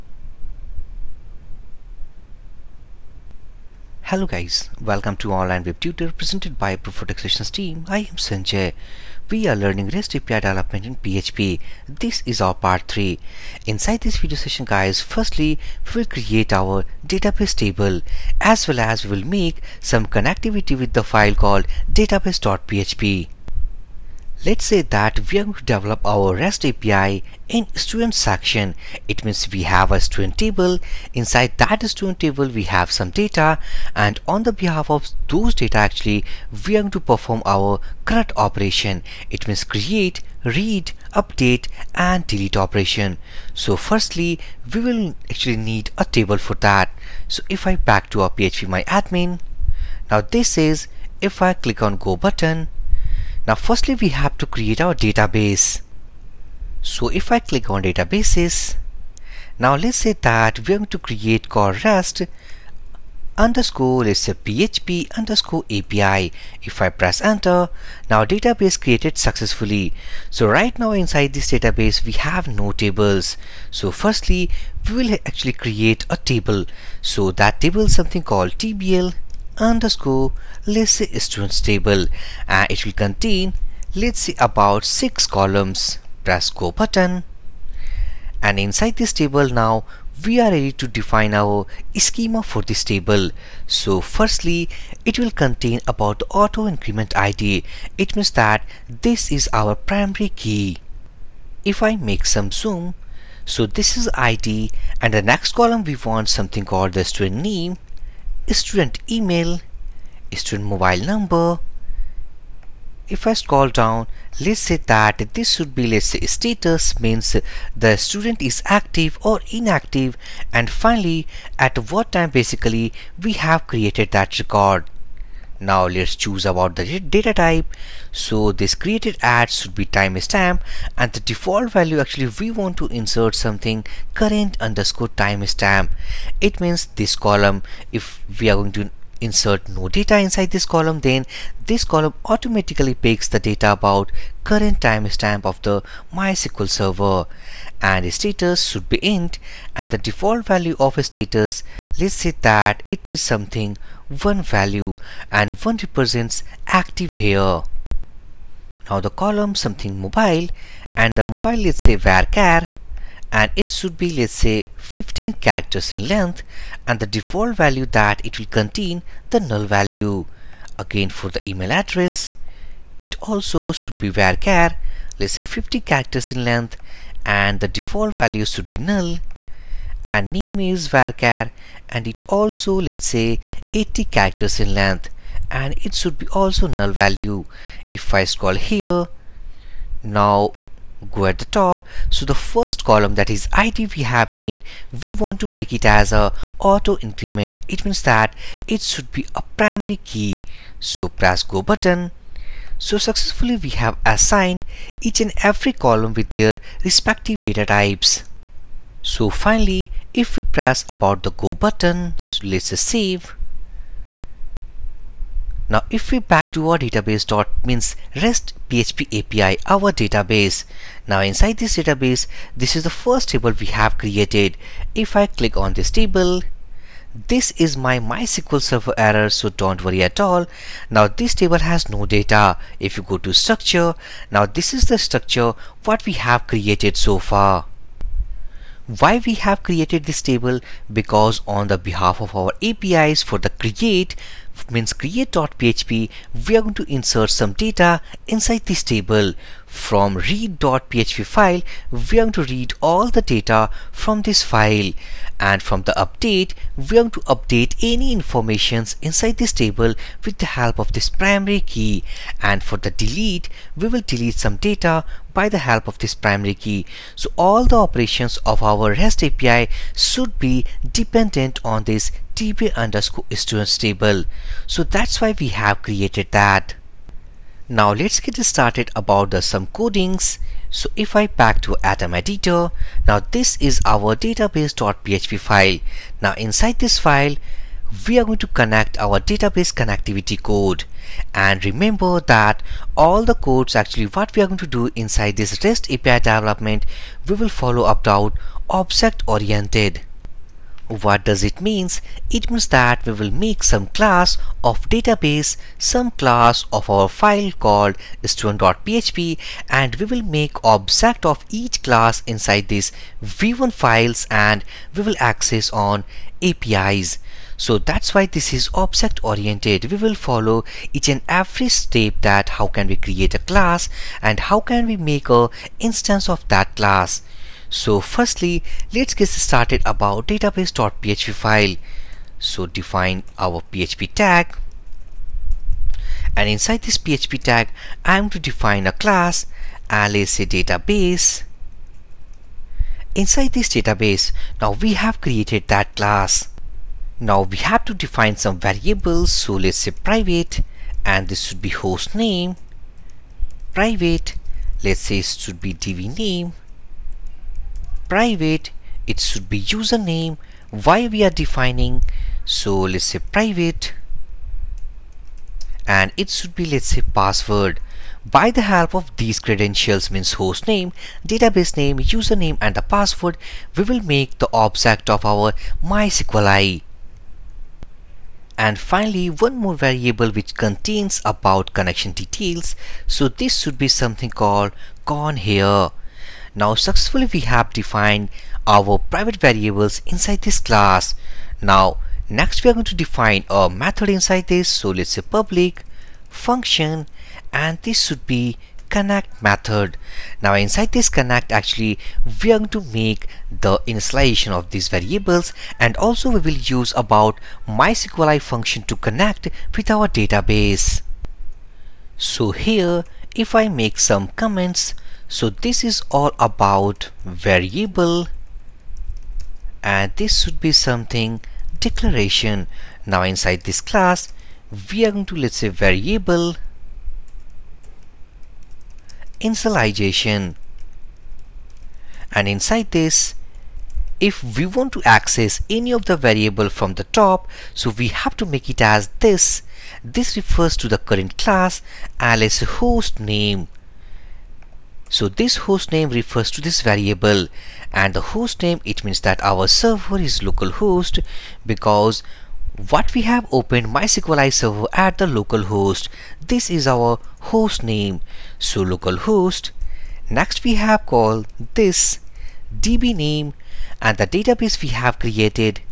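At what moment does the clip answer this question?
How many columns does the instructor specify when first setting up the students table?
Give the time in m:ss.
1:24.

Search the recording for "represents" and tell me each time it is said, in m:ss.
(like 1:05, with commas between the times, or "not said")
2:35.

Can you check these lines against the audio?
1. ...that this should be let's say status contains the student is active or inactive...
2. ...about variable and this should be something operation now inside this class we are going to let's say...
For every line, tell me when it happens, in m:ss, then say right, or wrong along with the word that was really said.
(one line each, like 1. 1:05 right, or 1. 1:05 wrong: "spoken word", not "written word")
1. 1:54 wrong: "means", not "contains"
2. 6:56 wrong: "declaration", not "operation".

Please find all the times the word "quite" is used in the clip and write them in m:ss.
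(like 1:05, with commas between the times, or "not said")
not said.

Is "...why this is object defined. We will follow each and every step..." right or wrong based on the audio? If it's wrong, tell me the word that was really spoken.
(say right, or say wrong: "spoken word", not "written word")
wrong: "oriented", not "defined".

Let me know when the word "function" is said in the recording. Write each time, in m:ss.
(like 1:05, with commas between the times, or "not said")
6:36, 6:48.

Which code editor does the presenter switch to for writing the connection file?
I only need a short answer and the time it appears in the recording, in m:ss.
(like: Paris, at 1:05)
Atom, at 4:41.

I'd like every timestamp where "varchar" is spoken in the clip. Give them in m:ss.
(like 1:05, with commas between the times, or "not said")
2:42, 2:54, 3:00.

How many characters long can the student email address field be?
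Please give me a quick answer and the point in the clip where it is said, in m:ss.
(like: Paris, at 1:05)
50, at 2:55.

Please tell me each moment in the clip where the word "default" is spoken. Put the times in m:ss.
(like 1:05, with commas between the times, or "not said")
2:11, 2:29, 2:47, 2:57.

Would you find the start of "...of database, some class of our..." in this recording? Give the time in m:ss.
5:04.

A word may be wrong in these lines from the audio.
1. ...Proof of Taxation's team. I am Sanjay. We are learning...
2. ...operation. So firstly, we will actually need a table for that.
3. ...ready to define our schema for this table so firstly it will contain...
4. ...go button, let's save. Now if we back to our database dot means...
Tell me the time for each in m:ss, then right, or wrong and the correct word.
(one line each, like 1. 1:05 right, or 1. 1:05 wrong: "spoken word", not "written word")
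1. 0:06 right
2. 0:42 right
3. 1:30 right
4. 3:31 right.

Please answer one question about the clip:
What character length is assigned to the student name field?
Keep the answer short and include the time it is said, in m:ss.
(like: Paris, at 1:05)
80, at 3:03.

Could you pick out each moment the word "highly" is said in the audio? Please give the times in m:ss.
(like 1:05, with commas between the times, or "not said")
not said.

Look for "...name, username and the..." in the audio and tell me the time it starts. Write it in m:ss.
6:11.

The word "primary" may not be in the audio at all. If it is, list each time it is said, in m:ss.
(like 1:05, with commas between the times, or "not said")
1:39, 3:19, 4:21, 4:26.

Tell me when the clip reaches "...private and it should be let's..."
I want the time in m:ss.
6:03.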